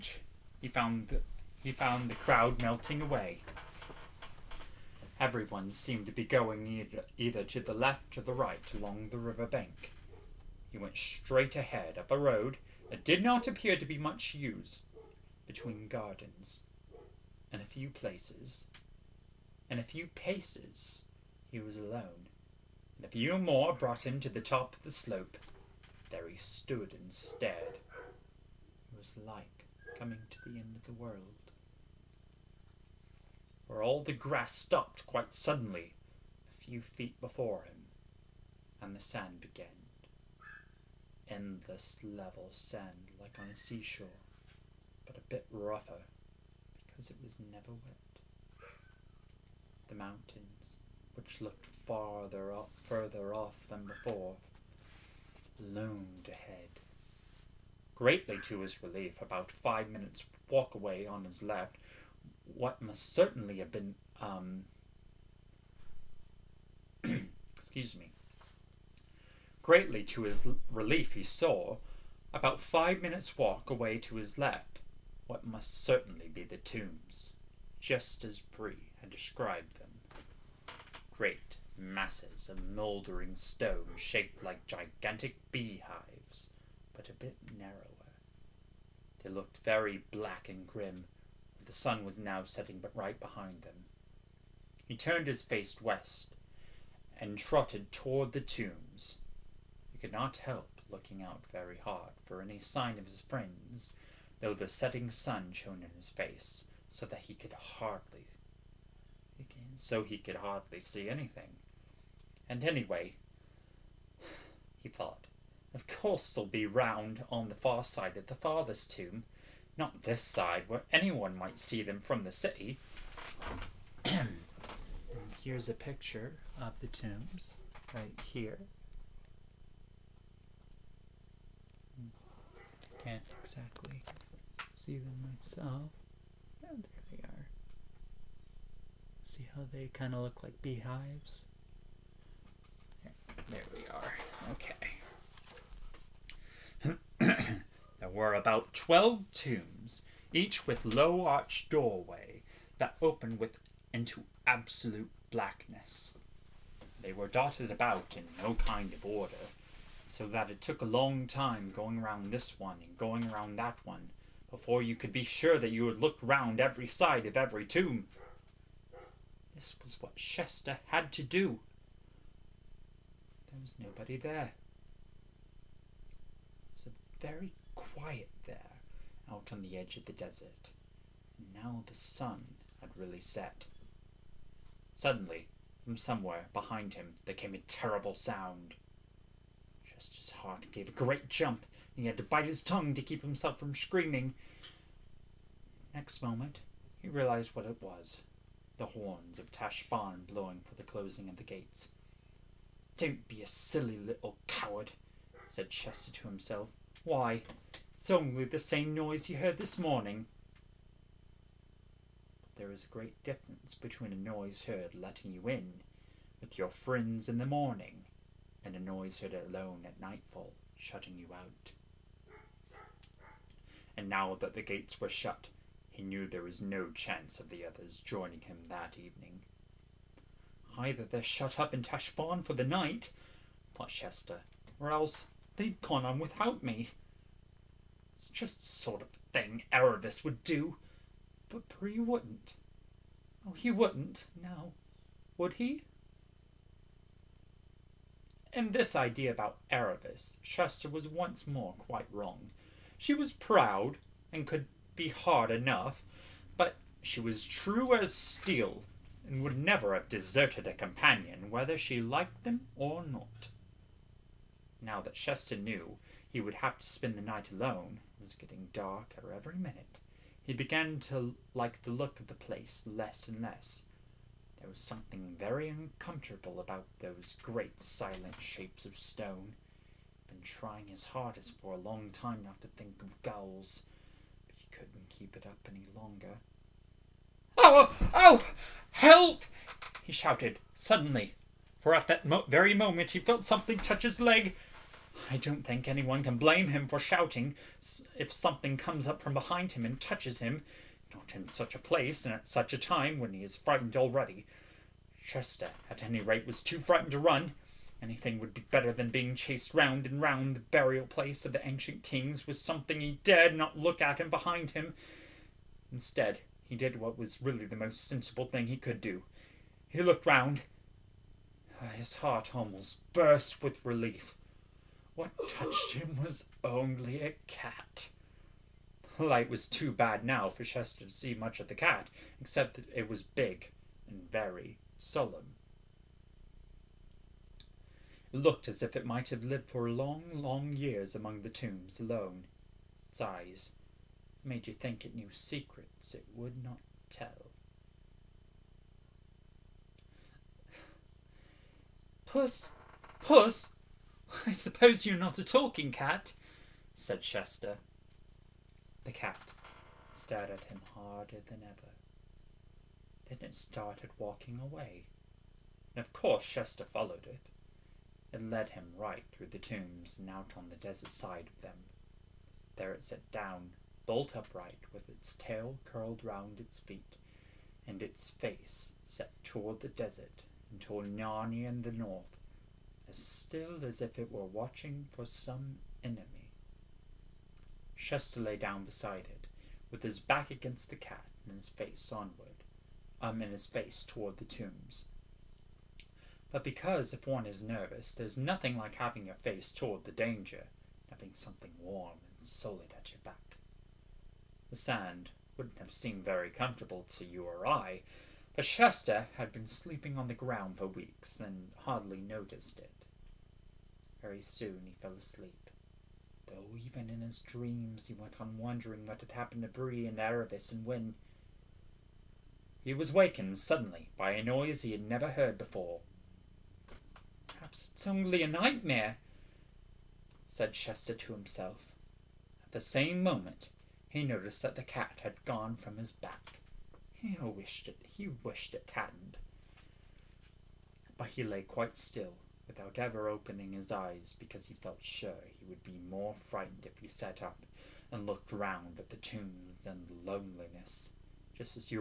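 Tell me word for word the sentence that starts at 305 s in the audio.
Shasta, at any rate, was too frightened to run.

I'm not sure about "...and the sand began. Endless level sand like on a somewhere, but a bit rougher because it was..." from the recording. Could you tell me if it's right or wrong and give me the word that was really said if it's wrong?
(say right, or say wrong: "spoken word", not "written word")
wrong: "seashore", not "somewhere".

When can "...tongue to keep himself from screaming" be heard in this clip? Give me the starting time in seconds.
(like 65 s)
192 s.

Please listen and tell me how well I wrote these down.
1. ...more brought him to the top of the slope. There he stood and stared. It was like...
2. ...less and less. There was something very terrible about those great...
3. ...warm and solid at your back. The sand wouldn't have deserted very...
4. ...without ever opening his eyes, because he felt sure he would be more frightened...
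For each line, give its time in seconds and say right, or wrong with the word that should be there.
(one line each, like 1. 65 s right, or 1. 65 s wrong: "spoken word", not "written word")
1. 23 s right
2. 272 s wrong: "uncomfortable", not "terrible"
3. 401 s wrong: "seemed", not "deserted"
4. 442 s right.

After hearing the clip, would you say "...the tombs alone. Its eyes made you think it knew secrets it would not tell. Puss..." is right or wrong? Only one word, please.
right.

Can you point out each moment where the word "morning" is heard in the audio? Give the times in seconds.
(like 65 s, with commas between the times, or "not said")
209 s, 217 s.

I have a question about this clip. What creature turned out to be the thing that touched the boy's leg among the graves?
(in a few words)
A cat.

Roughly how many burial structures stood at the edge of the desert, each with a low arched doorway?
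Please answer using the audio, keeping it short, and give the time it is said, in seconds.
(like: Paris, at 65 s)
12, at 148 s.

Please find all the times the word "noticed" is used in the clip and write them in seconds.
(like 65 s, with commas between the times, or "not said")
412 s, 434 s.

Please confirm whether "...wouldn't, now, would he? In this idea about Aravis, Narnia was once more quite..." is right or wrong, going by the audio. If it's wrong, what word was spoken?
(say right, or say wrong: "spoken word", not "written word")
wrong: "Shasta", not "Narnia".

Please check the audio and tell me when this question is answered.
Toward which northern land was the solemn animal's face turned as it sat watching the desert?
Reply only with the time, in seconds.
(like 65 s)
381 s.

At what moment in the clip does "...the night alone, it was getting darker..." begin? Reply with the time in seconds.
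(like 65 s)
267 s.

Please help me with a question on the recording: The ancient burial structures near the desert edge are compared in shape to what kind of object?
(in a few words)
Gigantic beehives.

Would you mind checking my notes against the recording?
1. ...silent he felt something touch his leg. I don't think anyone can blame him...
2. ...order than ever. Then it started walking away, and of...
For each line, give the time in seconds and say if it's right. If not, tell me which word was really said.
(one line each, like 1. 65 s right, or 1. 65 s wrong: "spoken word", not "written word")
1. 292 s wrong: "moment", not "silent"
2. 360 s wrong: "harder", not "order".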